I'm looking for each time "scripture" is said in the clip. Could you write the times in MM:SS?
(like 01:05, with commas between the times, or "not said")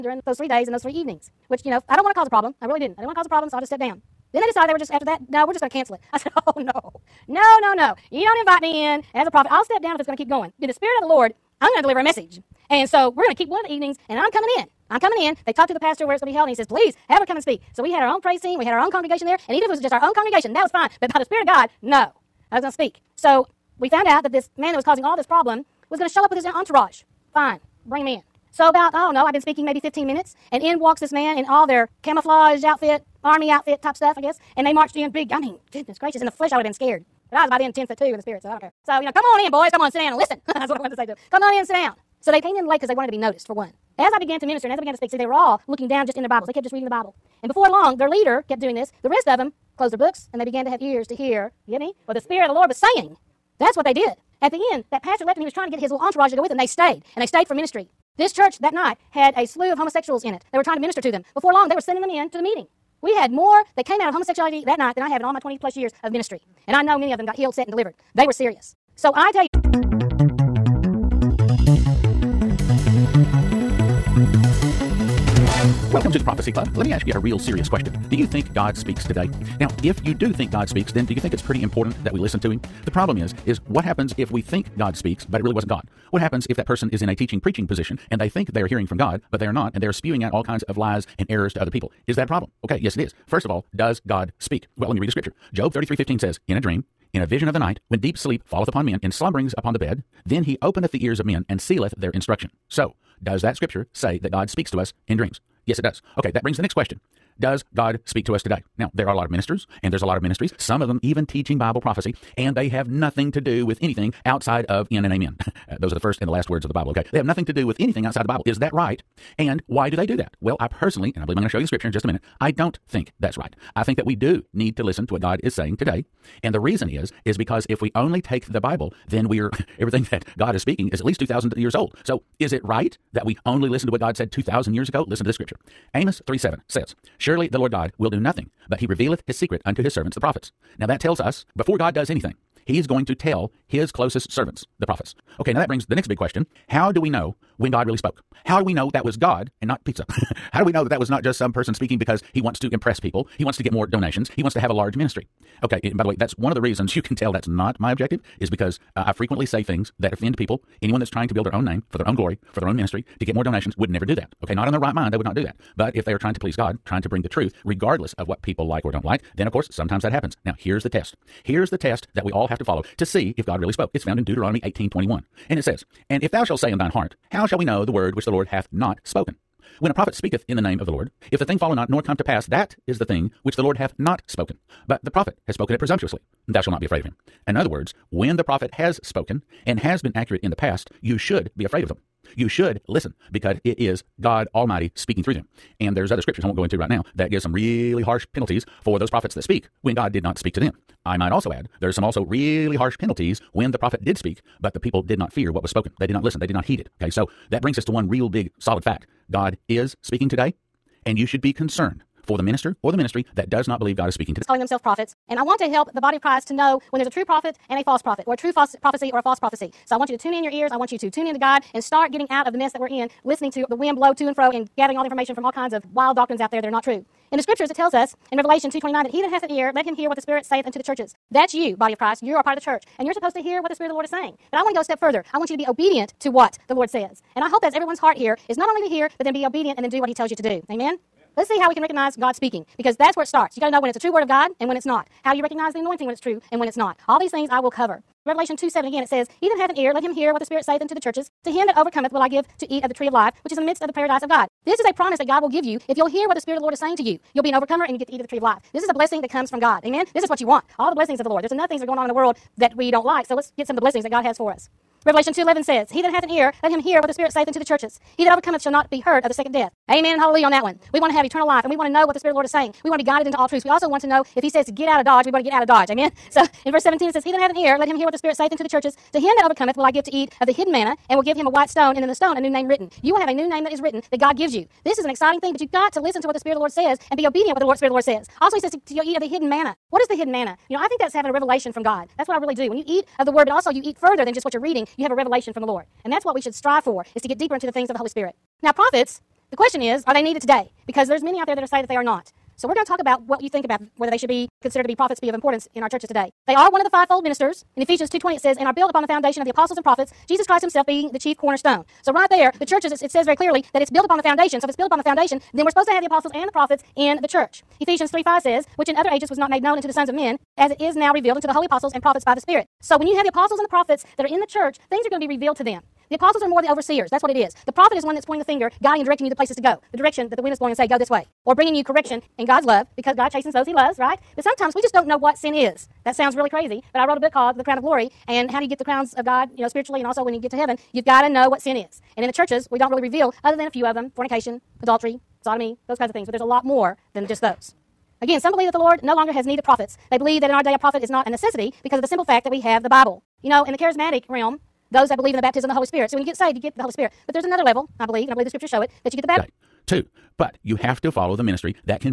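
01:35, 01:43, 02:01, 02:15, 03:16, 03:47, 05:58.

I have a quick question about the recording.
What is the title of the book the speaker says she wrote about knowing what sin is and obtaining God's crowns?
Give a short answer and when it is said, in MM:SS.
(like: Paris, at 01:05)
The Crown of Glory, at 05:37.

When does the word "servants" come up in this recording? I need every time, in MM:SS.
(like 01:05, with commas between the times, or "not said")
02:19, 02:24.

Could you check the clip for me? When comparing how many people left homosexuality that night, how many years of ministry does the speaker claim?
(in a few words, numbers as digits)
20 plus years.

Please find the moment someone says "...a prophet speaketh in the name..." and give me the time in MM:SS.
02:59.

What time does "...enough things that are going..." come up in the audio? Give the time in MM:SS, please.
04:21.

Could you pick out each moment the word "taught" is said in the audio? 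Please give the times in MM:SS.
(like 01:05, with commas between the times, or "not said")
not said.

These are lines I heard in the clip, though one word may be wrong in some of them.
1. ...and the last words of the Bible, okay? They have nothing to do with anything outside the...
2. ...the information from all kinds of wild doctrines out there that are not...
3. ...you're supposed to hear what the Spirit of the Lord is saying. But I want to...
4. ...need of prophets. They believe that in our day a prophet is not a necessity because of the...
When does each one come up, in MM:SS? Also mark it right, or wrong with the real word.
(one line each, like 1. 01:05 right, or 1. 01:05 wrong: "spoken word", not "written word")
1. 01:56 right
2. 03:45 right
3. 03:53 right
4. 05:49 right.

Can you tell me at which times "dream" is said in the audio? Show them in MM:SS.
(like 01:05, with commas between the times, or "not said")
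01:36, 01:45.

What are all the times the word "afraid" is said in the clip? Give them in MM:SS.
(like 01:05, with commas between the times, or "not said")
03:06, 03:11.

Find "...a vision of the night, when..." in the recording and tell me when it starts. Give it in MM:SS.
01:37.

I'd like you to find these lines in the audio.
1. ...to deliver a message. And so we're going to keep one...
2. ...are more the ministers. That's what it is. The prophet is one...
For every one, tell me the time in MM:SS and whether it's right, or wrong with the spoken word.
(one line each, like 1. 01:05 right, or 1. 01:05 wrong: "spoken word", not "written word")
1. 00:11 right
2. 05:26 wrong: "overseers", not "ministers".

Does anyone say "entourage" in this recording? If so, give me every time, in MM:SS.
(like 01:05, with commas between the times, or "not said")
00:26, 00:55.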